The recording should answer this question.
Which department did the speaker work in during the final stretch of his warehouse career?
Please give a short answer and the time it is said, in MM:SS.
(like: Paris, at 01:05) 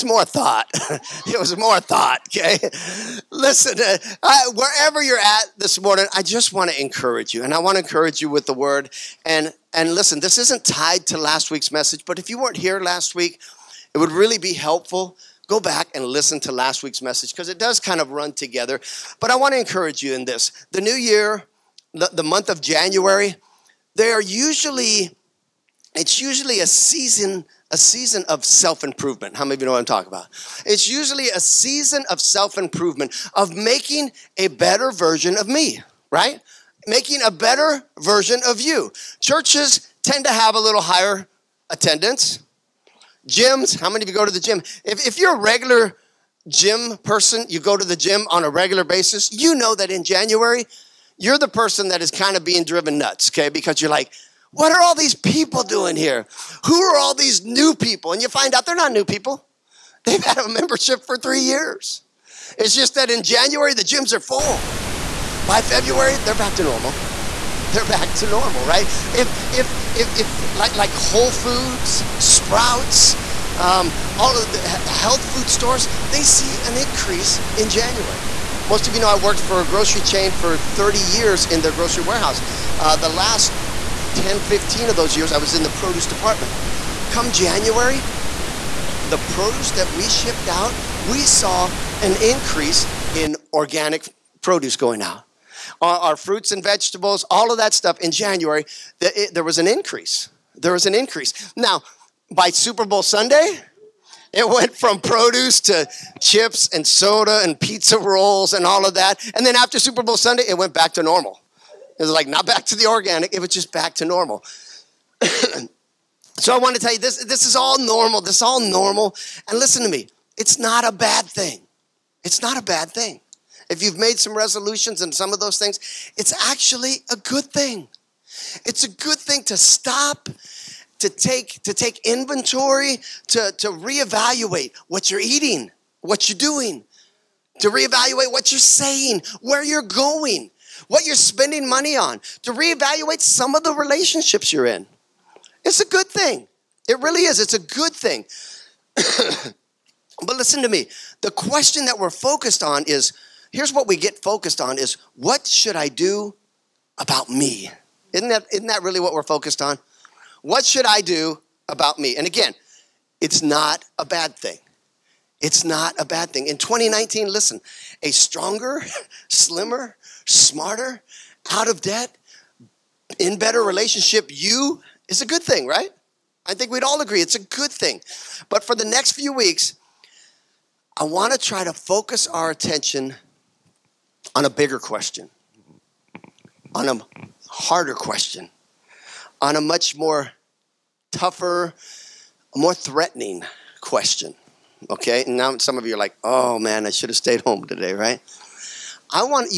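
produce department, at 01:25.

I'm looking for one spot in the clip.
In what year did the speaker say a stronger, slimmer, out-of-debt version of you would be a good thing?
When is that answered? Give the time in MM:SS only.
02:46.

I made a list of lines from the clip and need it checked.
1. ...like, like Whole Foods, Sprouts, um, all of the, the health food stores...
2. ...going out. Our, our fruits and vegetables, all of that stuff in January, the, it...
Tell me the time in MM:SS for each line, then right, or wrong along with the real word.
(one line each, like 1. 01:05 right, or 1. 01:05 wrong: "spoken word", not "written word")
1. 01:10 right
2. 01:34 right.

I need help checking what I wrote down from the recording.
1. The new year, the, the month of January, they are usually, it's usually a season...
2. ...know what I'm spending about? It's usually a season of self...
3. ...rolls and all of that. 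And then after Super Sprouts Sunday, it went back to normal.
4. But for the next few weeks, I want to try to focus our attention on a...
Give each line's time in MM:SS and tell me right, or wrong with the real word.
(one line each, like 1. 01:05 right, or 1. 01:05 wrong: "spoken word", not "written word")
1. 00:20 right
2. 00:29 wrong: "talking", not "spending"
3. 01:47 wrong: "Bowl", not "Sprouts"
4. 02:58 right.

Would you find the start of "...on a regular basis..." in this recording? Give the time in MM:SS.
00:48.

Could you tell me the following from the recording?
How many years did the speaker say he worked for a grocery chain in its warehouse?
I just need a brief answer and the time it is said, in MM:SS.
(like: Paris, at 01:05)
30, at 01:20.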